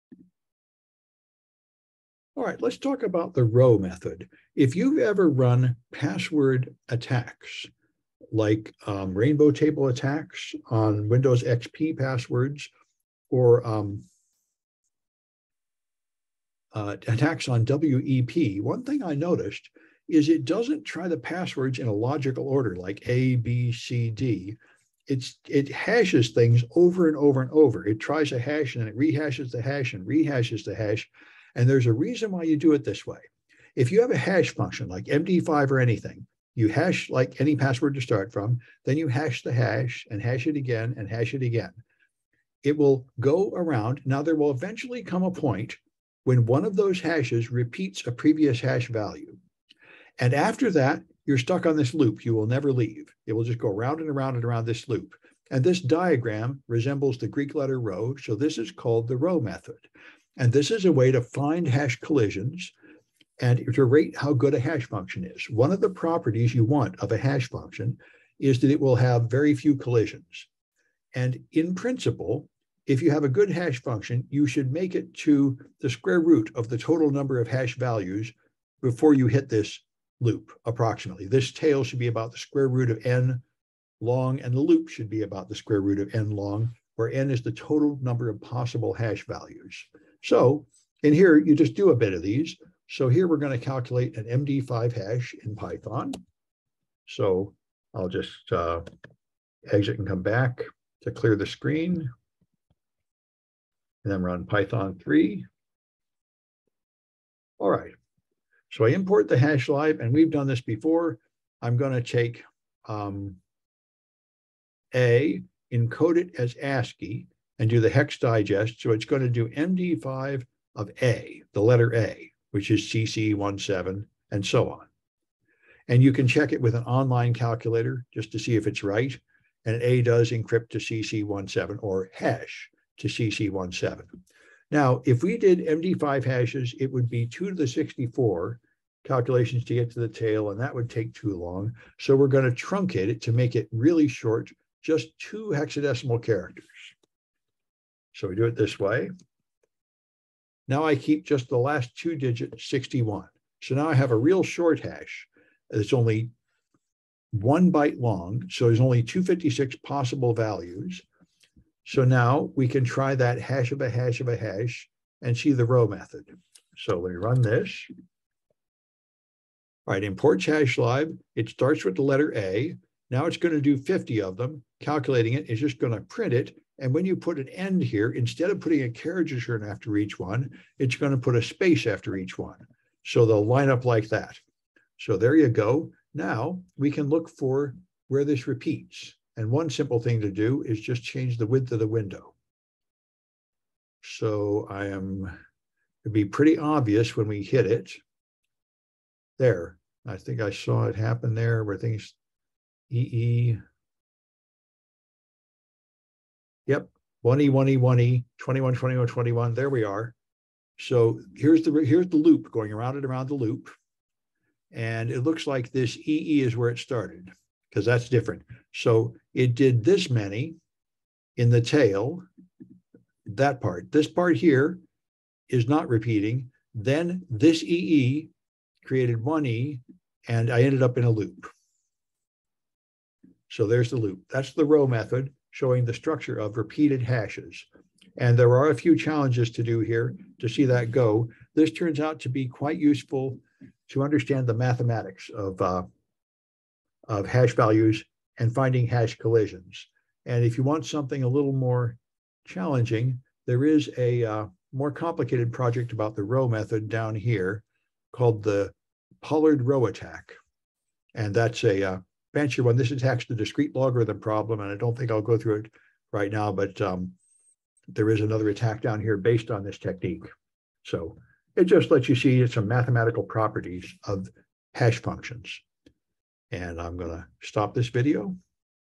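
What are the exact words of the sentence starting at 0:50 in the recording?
And after that, you're stuck on this loop.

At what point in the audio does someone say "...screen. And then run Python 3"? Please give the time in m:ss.
1:41.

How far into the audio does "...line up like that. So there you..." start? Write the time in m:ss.
3:03.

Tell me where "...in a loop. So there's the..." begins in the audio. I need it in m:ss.
3:50.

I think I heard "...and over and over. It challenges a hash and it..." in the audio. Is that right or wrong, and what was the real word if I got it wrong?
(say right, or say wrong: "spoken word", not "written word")
wrong: "tries", not "challenges".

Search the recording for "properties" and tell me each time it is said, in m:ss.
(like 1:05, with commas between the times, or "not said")
1:05, 4:33.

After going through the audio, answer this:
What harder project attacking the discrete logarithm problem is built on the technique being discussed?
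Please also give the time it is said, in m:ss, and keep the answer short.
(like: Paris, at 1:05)
Pollard rho attack, at 4:19.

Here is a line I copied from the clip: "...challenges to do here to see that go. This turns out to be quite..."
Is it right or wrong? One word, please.
right.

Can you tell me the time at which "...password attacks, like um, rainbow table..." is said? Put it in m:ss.
0:05.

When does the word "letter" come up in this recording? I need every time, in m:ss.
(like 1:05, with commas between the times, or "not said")
0:57, 2:01, 2:52.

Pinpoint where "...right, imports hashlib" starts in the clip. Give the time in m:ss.
2:49.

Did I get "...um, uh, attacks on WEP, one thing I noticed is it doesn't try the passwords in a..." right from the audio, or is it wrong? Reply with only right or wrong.
right.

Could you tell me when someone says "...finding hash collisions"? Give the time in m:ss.
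4:08.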